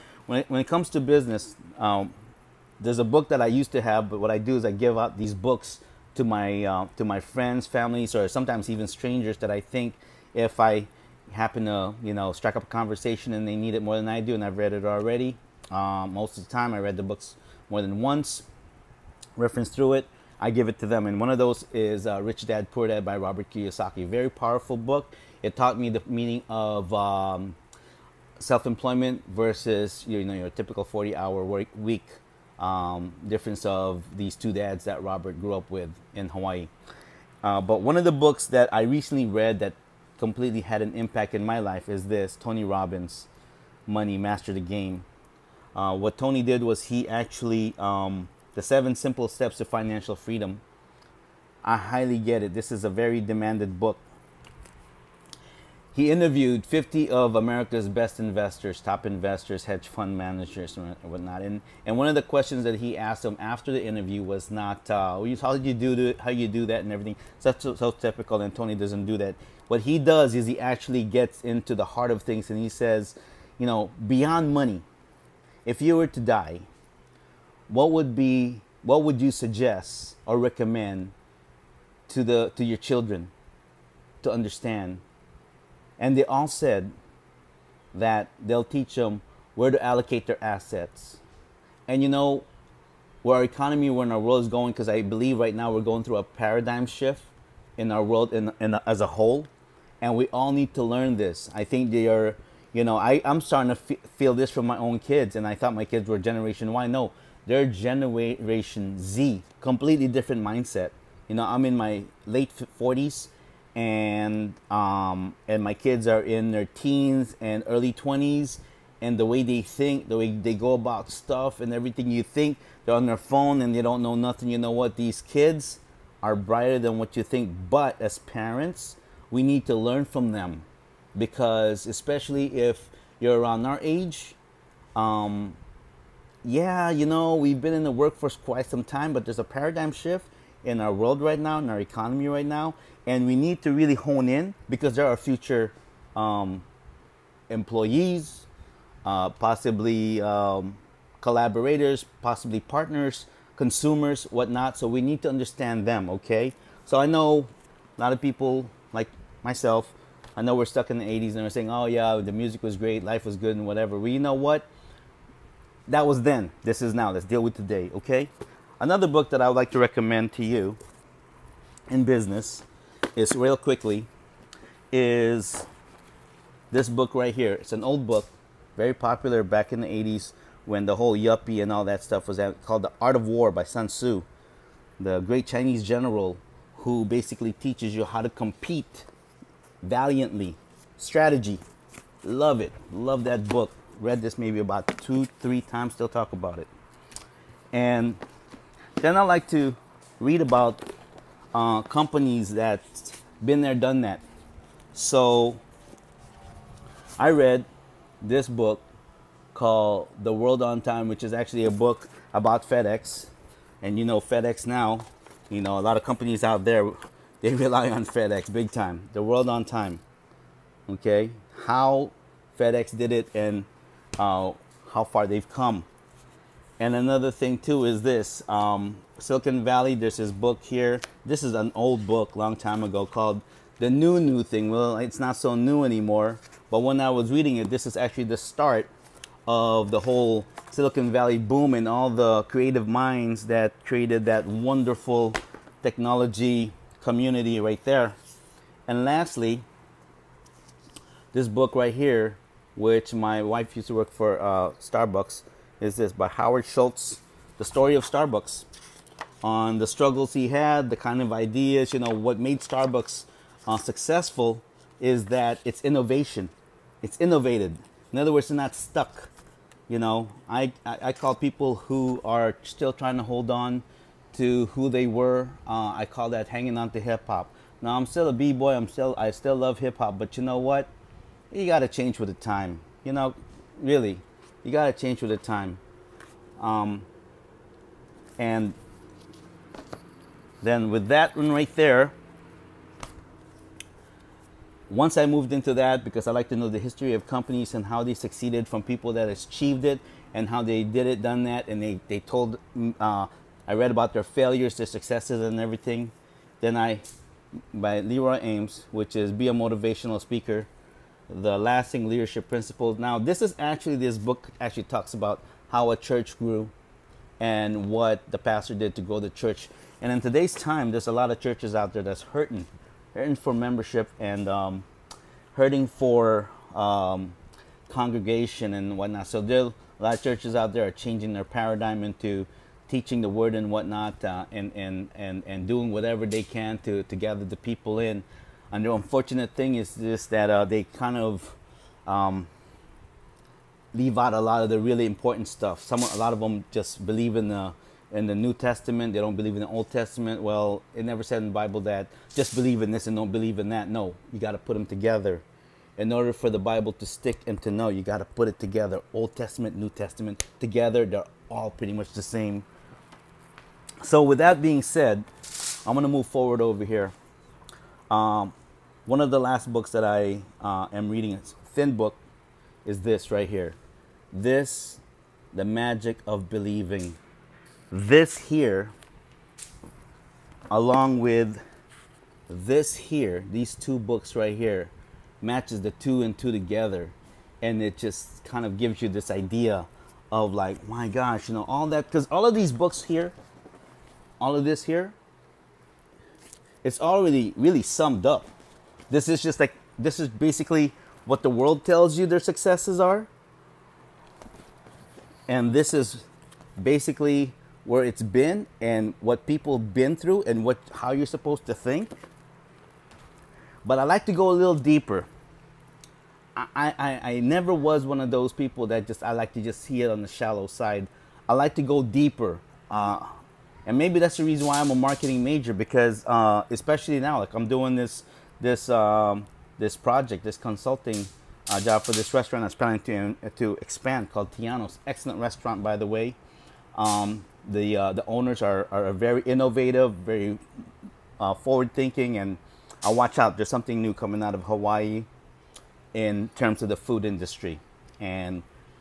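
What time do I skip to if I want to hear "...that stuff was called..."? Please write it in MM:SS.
03:01.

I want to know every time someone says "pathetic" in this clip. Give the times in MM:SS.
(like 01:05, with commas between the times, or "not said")
not said.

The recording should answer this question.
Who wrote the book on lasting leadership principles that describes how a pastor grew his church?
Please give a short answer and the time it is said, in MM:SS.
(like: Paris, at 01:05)
Leroy Eims, at 05:08.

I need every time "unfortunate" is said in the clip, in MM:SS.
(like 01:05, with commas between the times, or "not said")
05:38.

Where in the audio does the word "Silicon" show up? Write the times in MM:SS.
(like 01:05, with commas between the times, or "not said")
03:49, 04:00.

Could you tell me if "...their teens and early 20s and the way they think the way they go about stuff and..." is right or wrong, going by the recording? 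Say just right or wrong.
right.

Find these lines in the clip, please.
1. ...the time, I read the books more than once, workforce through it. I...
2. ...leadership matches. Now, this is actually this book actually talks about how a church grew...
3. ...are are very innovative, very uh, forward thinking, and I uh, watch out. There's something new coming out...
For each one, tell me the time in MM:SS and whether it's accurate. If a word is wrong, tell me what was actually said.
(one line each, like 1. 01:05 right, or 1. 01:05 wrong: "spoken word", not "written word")
1. 00:16 wrong: "reference", not "workforce"
2. 05:12 wrong: "principles", not "matches"
3. 07:18 right.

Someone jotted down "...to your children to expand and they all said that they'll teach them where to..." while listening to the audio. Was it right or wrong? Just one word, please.
wrong.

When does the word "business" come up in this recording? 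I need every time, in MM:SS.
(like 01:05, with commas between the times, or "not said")
00:01, 02:52.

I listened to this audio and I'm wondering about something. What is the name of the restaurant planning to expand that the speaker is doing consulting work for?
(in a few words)
Tiano's.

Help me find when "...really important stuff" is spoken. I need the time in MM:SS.
05:44.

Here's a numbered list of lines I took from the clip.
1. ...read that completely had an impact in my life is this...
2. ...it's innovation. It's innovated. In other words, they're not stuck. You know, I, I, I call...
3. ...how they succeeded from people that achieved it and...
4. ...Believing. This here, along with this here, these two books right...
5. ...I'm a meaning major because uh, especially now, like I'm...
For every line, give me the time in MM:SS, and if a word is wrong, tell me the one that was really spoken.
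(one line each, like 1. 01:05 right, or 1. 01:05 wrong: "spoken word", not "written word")
1. 00:39 right
2. 04:25 right
3. 04:57 right
4. 06:16 right
5. 07:04 wrong: "marketing", not "meaning".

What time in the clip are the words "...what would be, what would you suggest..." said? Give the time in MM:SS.
01:17.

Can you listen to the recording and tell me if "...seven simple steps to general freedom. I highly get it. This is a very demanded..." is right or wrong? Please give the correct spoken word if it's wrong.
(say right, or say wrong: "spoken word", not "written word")
wrong: "financial", not "general".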